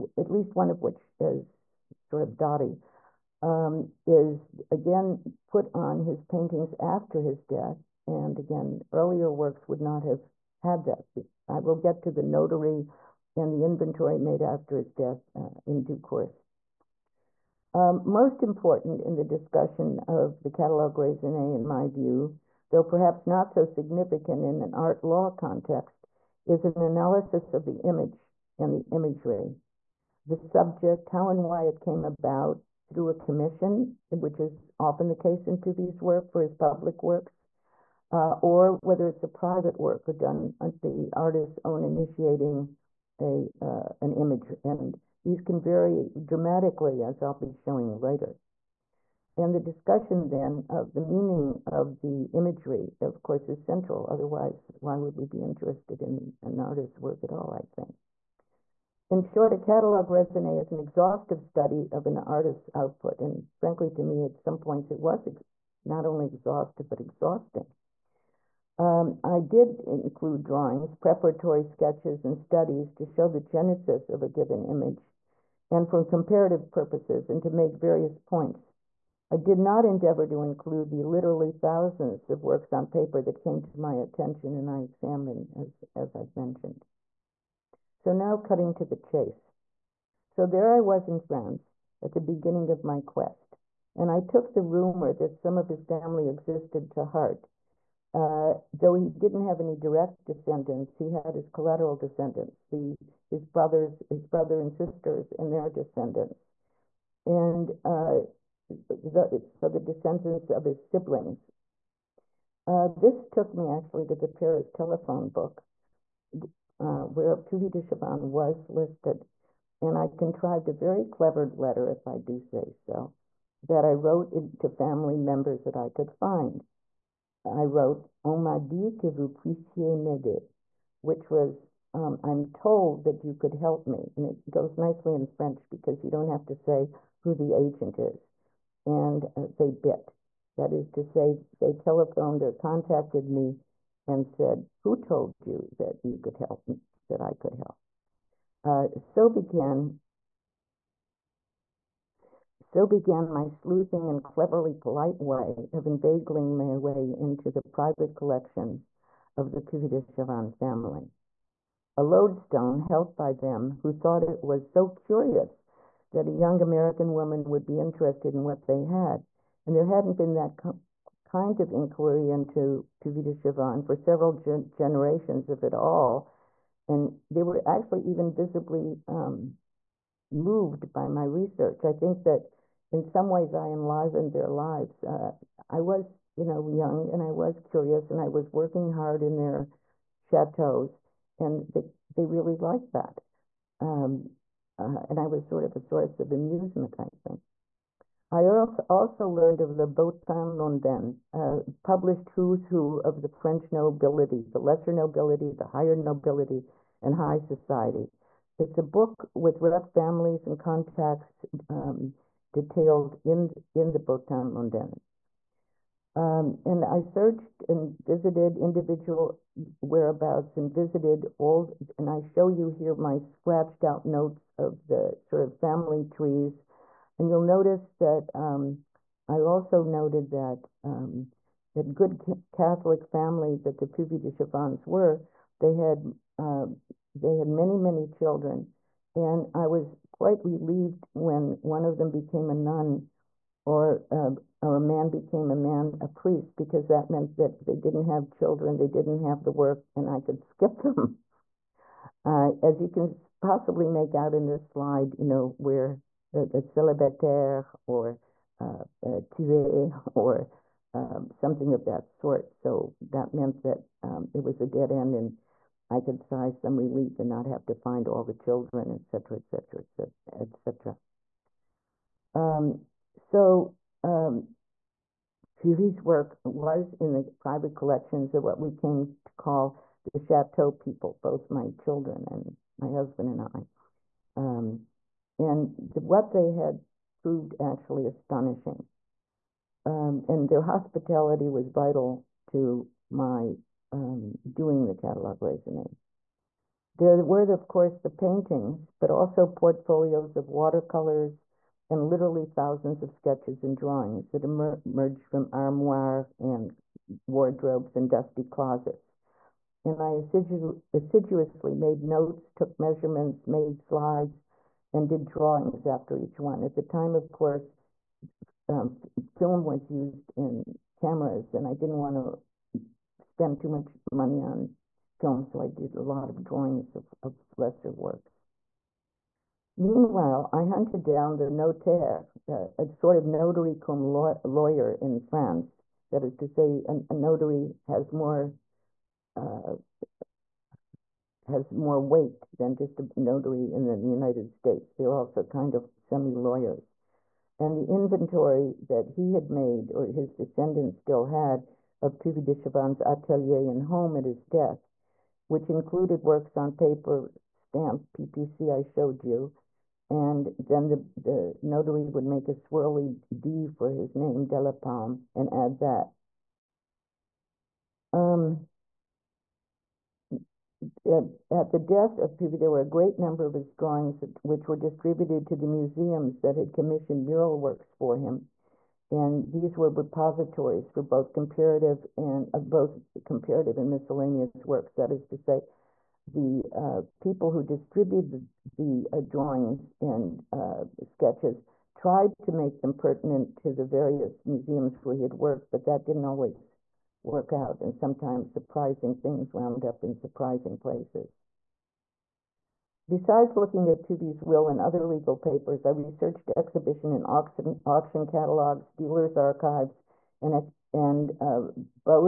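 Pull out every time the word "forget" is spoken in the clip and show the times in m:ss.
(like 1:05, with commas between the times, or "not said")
not said.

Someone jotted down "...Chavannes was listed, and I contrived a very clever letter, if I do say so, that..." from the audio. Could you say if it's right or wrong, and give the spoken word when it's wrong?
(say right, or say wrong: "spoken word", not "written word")
right.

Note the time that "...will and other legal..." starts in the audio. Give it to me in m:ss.
6:44.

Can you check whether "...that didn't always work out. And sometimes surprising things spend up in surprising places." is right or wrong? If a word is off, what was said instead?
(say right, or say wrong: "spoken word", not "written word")
wrong: "wound", not "spend".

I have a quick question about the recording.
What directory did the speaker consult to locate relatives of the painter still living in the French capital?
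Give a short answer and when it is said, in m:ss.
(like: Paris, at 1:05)
Paris telephone book, at 1:54.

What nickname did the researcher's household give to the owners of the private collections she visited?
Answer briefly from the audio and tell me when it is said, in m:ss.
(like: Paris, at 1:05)
the Chateau people, at 4:40.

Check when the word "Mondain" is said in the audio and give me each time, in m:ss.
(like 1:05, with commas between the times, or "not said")
3:20, 3:34.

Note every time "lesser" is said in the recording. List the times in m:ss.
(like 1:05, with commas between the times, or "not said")
3:24, 5:27.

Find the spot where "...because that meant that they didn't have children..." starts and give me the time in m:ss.
4:06.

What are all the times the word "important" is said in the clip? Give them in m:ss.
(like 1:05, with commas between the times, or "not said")
0:18.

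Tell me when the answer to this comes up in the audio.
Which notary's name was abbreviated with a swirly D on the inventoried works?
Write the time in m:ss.
6:04.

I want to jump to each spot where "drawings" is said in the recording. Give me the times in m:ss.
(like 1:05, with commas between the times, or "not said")
1:10, 5:03, 5:15, 5:26, 6:13, 6:29.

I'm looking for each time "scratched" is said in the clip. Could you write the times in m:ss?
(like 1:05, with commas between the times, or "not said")
3:43.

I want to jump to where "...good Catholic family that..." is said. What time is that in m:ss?
3:51.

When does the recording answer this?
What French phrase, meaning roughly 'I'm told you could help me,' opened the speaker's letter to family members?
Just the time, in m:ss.
2:08.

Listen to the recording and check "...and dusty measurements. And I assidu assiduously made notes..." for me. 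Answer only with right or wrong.
wrong.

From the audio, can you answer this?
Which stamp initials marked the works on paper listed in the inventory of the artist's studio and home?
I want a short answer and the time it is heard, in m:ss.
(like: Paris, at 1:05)
PPC, at 5:58.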